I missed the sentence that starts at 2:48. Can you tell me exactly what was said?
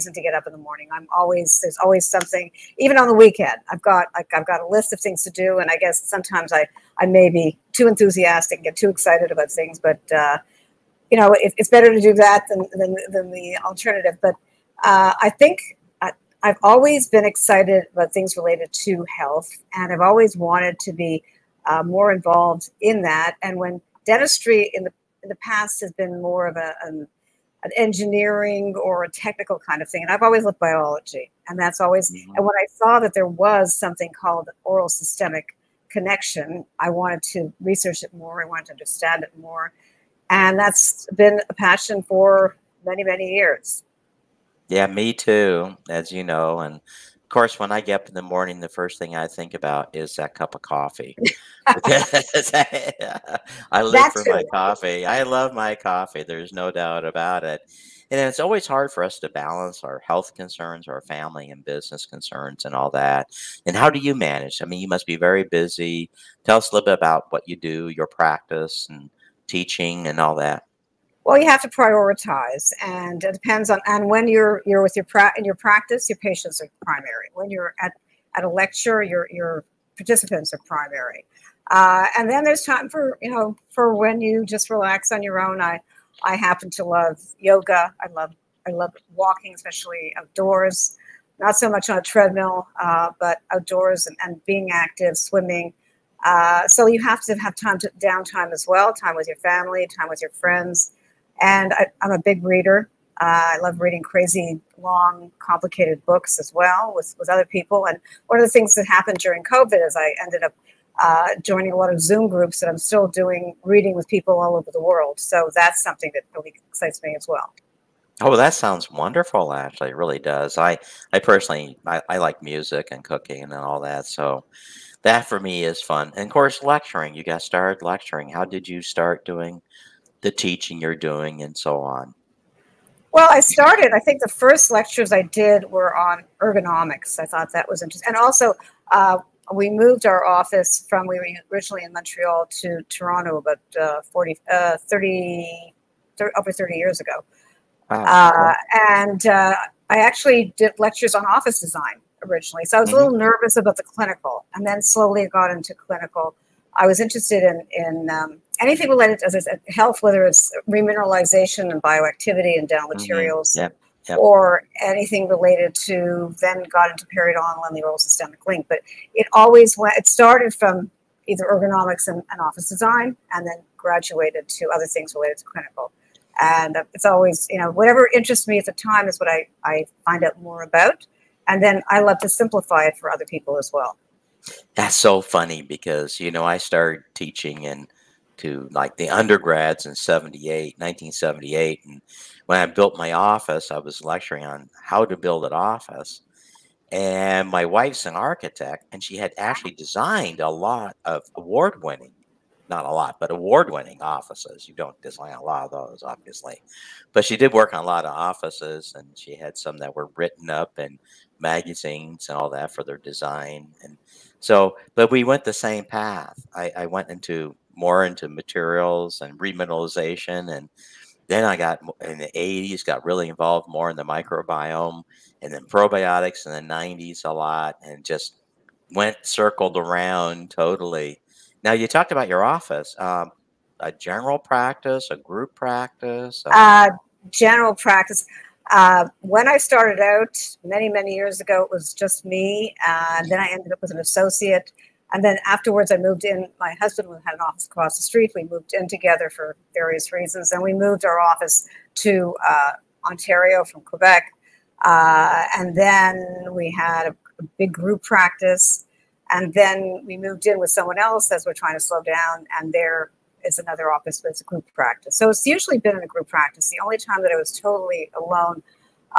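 But it always went, it started from either ergonomics and, and office design and then graduated to other things related to clinical.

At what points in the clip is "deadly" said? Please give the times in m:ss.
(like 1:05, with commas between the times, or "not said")
not said.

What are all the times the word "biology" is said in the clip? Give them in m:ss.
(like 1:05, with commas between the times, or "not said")
0:30.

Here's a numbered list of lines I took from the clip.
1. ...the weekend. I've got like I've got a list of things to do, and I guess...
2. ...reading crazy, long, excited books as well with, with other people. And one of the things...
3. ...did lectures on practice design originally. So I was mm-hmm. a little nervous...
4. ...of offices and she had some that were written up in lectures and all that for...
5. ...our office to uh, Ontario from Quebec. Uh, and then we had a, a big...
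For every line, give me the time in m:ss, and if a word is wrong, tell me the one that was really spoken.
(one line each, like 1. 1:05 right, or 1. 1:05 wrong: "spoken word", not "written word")
1. 0:03 right
2. 1:43 wrong: "complicated", not "excited"
3. 2:30 wrong: "office", not "practice"
4. 3:28 wrong: "magazines", not "lectures"
5. 4:11 right.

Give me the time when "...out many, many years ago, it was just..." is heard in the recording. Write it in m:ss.
3:59.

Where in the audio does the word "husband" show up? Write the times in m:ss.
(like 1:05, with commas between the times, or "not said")
4:06.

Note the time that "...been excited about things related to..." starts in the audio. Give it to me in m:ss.
0:17.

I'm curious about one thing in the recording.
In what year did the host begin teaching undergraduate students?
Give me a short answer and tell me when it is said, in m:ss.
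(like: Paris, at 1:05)
1978, at 3:10.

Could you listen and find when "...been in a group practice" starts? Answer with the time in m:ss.
4:25.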